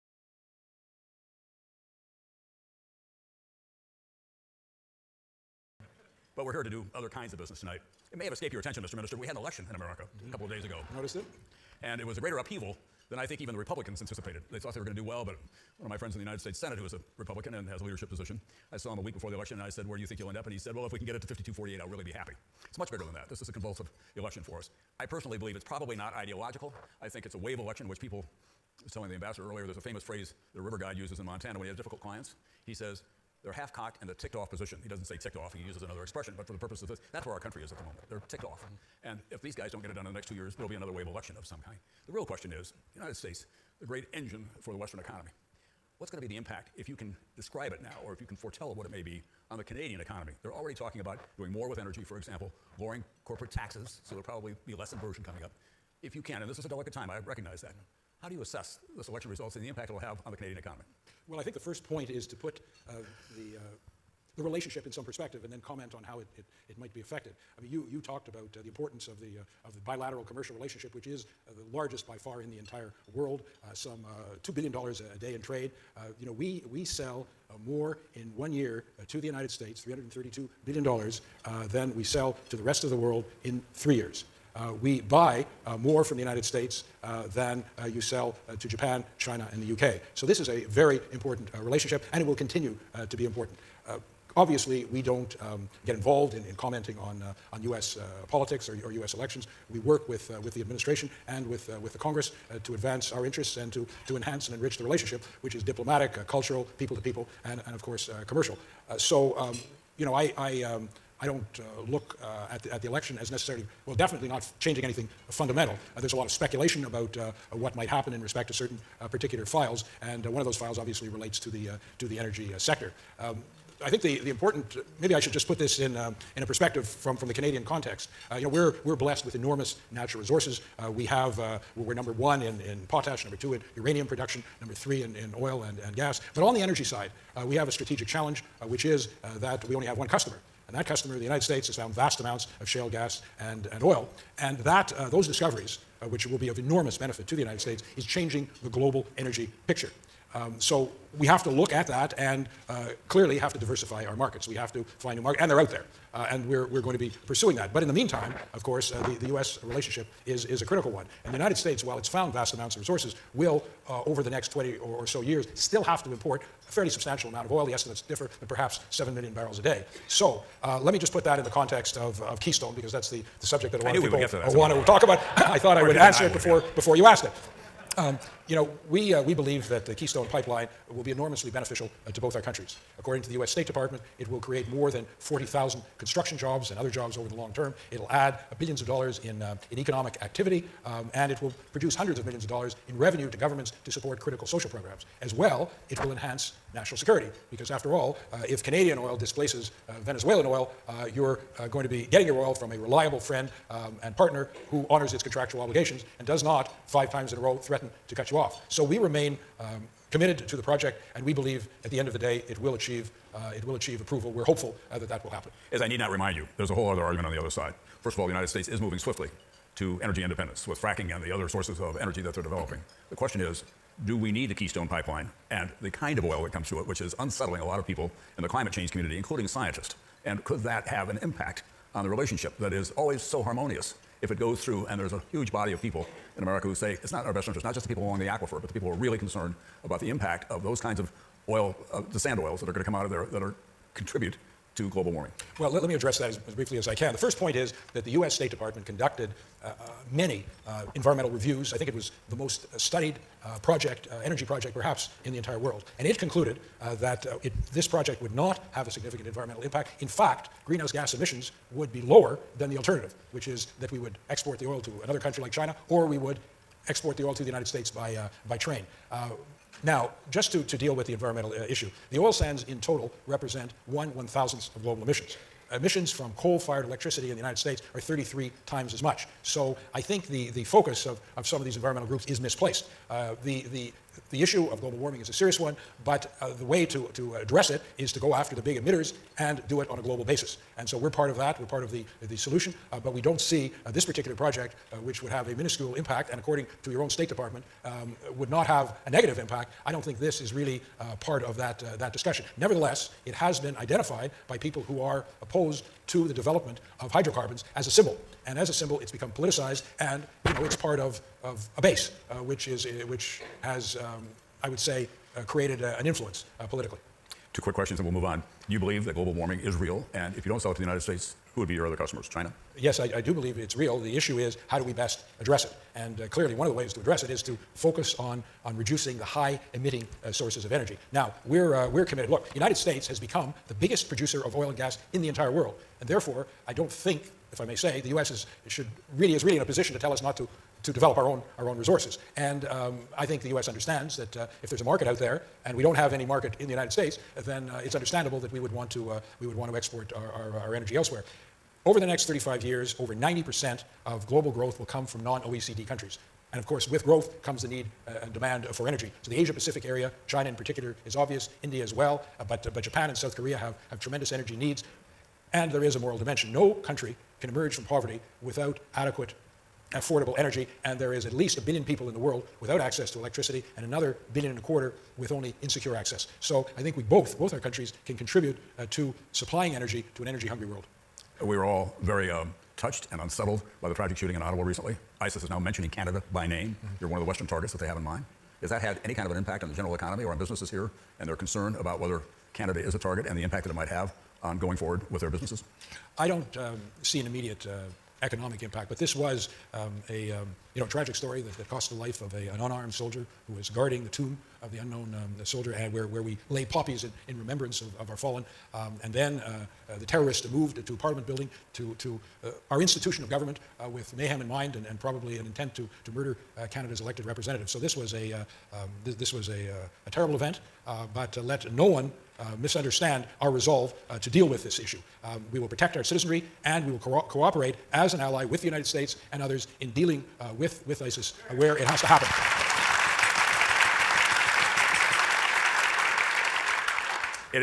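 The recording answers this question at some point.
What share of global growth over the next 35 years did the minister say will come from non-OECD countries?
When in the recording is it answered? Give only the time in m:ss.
5:52.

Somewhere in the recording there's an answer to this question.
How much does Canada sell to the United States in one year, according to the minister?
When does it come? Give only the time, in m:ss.
1:19.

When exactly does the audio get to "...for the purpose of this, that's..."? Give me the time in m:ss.
0:36.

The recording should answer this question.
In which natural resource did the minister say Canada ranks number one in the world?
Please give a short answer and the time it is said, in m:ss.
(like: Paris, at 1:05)
Potash, at 2:12.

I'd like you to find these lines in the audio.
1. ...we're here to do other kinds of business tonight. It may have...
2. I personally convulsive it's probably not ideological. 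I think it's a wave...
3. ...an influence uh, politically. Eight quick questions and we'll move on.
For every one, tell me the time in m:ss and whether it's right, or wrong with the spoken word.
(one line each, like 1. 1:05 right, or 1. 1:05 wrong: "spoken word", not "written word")
1. 0:06 right
2. 0:24 wrong: "believe", not "convulsive"
3. 5:15 wrong: "Two", not "Eight".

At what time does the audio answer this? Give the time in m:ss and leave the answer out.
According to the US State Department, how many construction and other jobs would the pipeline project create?
3:04.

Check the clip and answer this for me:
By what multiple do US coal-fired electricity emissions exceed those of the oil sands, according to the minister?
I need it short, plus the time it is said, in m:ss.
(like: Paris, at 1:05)
33 times, at 4:37.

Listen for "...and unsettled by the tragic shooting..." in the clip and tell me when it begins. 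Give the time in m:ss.
6:23.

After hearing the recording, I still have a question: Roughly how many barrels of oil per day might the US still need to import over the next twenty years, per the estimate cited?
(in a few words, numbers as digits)
7 million.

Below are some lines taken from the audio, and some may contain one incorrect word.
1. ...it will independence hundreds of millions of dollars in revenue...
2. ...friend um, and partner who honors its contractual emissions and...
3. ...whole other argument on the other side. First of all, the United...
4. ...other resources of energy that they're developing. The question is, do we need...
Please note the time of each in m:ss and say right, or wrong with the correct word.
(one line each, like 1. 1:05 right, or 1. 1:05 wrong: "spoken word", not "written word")
1. 3:11 wrong: "produce", not "independence"
2. 3:23 wrong: "obligations", not "emissions"
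3. 3:36 right
4. 3:41 wrong: "sources", not "resources".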